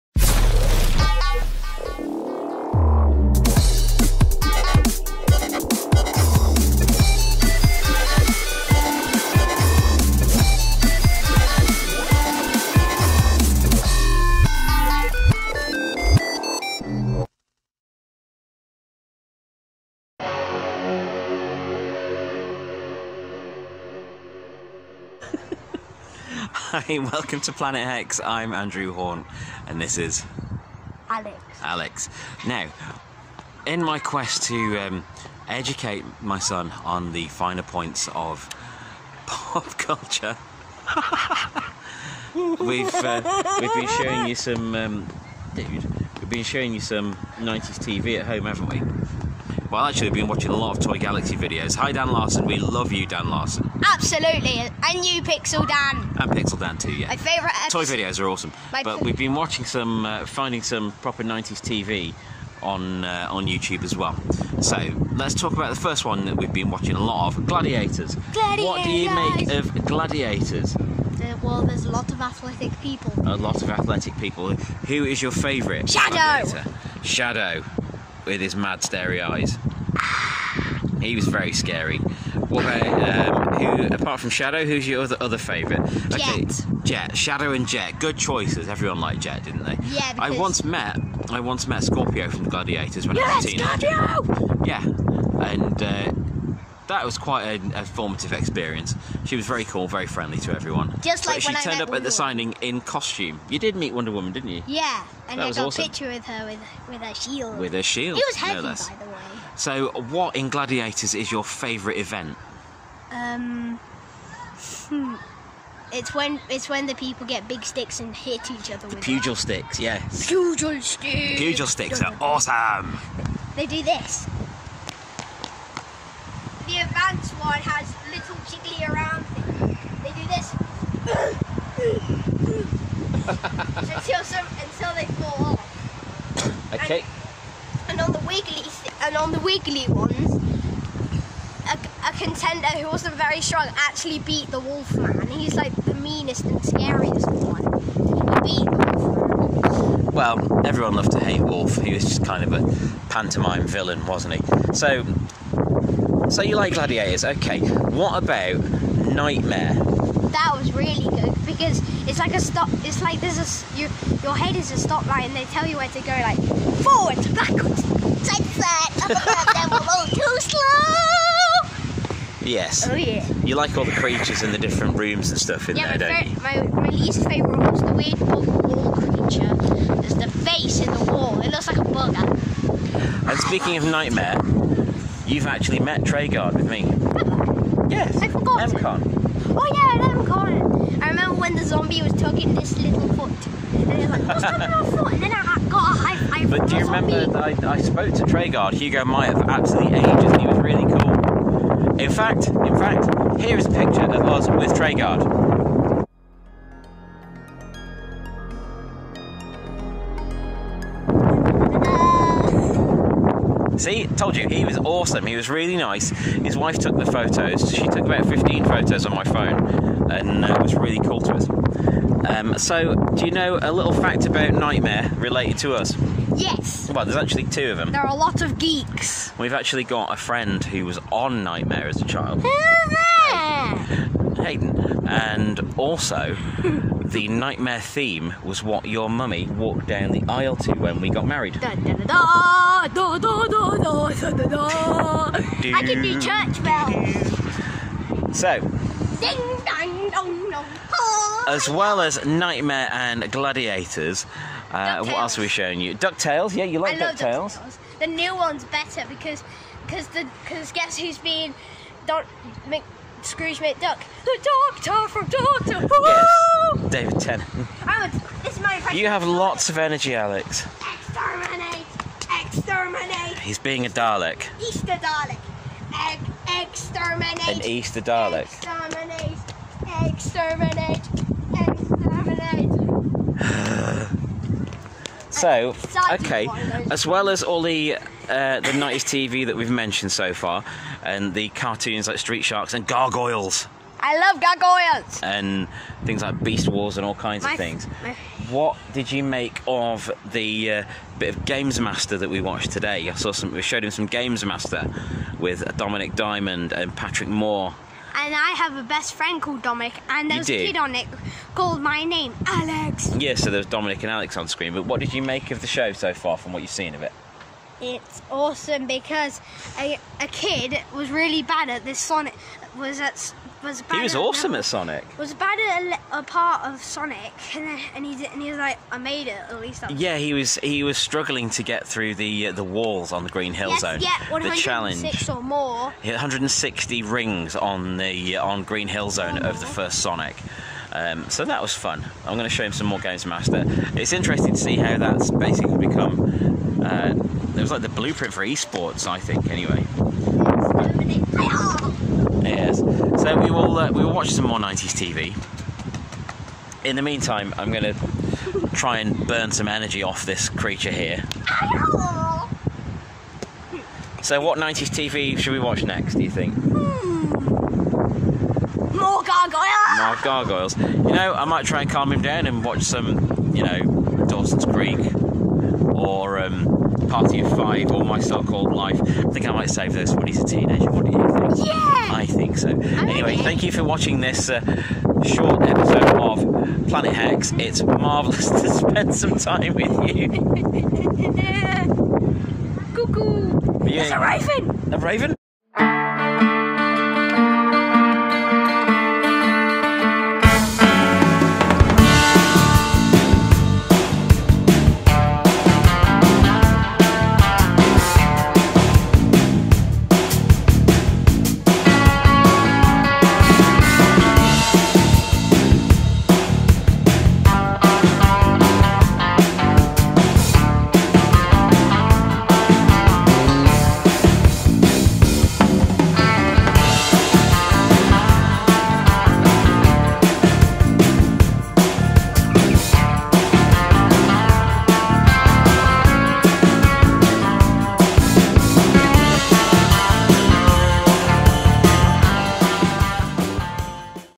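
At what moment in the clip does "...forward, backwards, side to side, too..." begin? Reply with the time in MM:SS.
02:46.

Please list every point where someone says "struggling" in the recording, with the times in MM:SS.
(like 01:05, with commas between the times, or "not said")
05:30.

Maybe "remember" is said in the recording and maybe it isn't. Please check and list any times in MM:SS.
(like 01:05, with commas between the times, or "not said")
03:11, 03:16.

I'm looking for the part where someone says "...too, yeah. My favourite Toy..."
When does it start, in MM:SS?
00:56.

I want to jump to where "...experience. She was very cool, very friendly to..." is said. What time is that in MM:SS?
01:38.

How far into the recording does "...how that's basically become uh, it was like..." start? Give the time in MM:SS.
05:44.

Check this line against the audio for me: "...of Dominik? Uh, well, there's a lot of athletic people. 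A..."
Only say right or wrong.
wrong.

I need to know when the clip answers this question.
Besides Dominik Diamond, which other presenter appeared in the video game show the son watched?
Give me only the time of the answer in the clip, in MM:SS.
05:06.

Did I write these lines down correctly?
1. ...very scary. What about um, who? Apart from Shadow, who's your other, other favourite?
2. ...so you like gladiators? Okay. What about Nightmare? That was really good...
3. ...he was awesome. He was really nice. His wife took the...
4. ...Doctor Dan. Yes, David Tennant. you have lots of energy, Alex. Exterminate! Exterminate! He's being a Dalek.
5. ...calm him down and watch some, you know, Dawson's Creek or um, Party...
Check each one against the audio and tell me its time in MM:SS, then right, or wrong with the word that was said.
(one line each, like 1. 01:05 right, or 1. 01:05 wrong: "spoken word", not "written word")
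1. 01:21 right
2. 02:36 right
3. 03:34 right
4. 04:25 wrong: "Who", not "Dan"
5. 06:11 right.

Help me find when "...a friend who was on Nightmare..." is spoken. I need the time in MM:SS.
03:50.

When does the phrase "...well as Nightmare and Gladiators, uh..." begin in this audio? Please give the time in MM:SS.
04:11.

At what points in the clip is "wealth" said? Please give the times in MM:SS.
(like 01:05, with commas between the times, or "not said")
not said.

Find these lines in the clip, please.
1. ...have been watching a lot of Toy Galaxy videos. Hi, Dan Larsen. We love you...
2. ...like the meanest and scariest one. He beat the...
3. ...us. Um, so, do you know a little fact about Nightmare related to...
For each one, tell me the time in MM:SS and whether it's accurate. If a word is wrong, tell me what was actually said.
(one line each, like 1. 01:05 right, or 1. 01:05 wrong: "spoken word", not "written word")
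1. 00:50 right
2. 02:25 right
3. 03:41 right.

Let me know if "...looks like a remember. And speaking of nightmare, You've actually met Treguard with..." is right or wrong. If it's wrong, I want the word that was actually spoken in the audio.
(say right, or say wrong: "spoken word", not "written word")
wrong: "bugger", not "remember".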